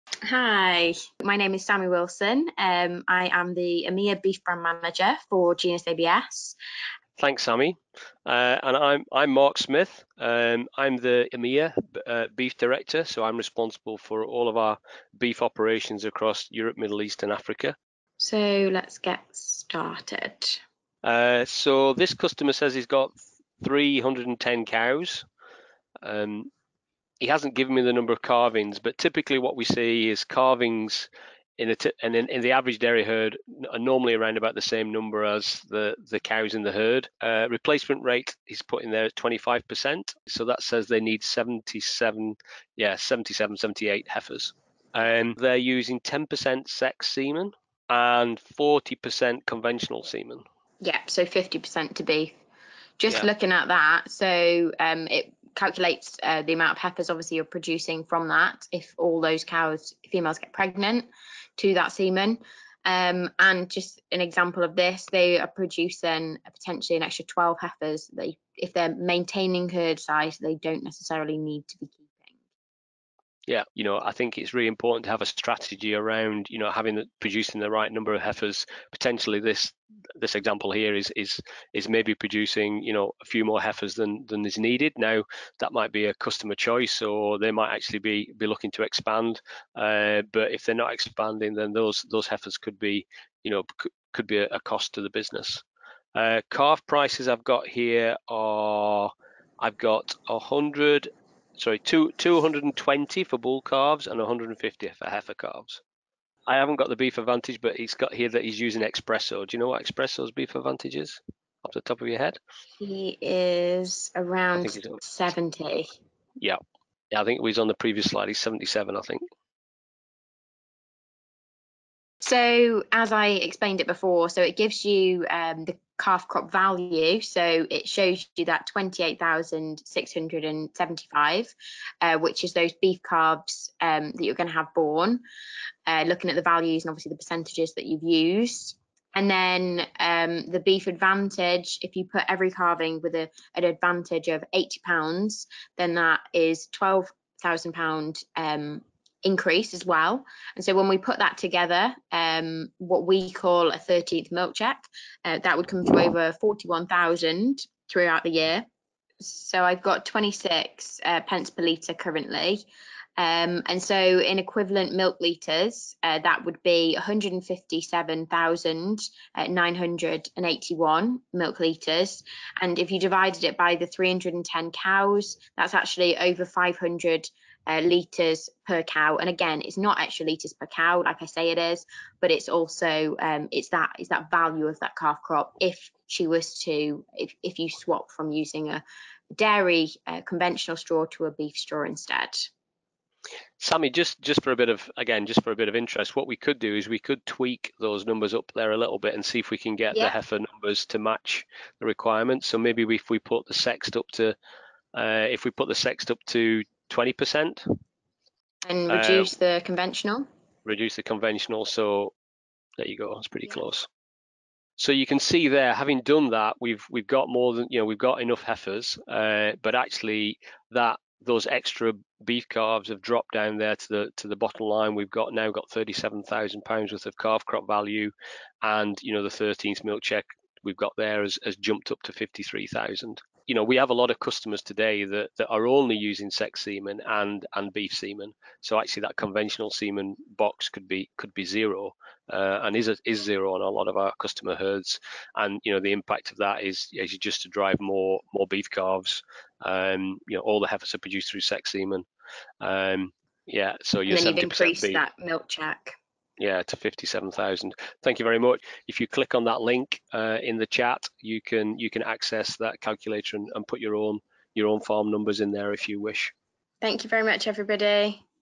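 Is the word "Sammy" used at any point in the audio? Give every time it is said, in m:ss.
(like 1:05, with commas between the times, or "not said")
0:01, 0:07, 3:13.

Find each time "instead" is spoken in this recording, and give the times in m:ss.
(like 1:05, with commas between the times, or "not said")
3:11.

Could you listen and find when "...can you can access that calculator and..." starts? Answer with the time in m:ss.
4:21.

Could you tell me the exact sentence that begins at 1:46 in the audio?
I haven't got the beef advantage, but he's got here that he's using espresso.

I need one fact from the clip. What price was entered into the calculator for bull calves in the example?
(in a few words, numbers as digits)
220.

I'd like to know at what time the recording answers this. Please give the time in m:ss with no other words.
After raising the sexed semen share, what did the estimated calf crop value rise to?
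3:45.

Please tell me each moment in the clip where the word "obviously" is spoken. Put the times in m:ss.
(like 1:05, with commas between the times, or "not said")
0:57, 2:16.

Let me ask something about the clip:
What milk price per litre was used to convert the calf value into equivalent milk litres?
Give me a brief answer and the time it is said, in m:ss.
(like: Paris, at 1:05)
26 pence, at 2:40.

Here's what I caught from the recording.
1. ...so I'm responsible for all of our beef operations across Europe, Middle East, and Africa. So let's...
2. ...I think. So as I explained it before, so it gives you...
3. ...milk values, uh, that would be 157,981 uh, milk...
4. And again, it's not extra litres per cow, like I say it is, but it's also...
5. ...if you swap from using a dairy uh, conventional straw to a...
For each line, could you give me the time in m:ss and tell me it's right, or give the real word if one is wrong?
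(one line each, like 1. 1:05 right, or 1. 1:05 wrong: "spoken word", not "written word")
1. 0:13 right
2. 1:58 right
3. 2:44 wrong: "litres", not "values"
4. 2:59 right
5. 3:07 right.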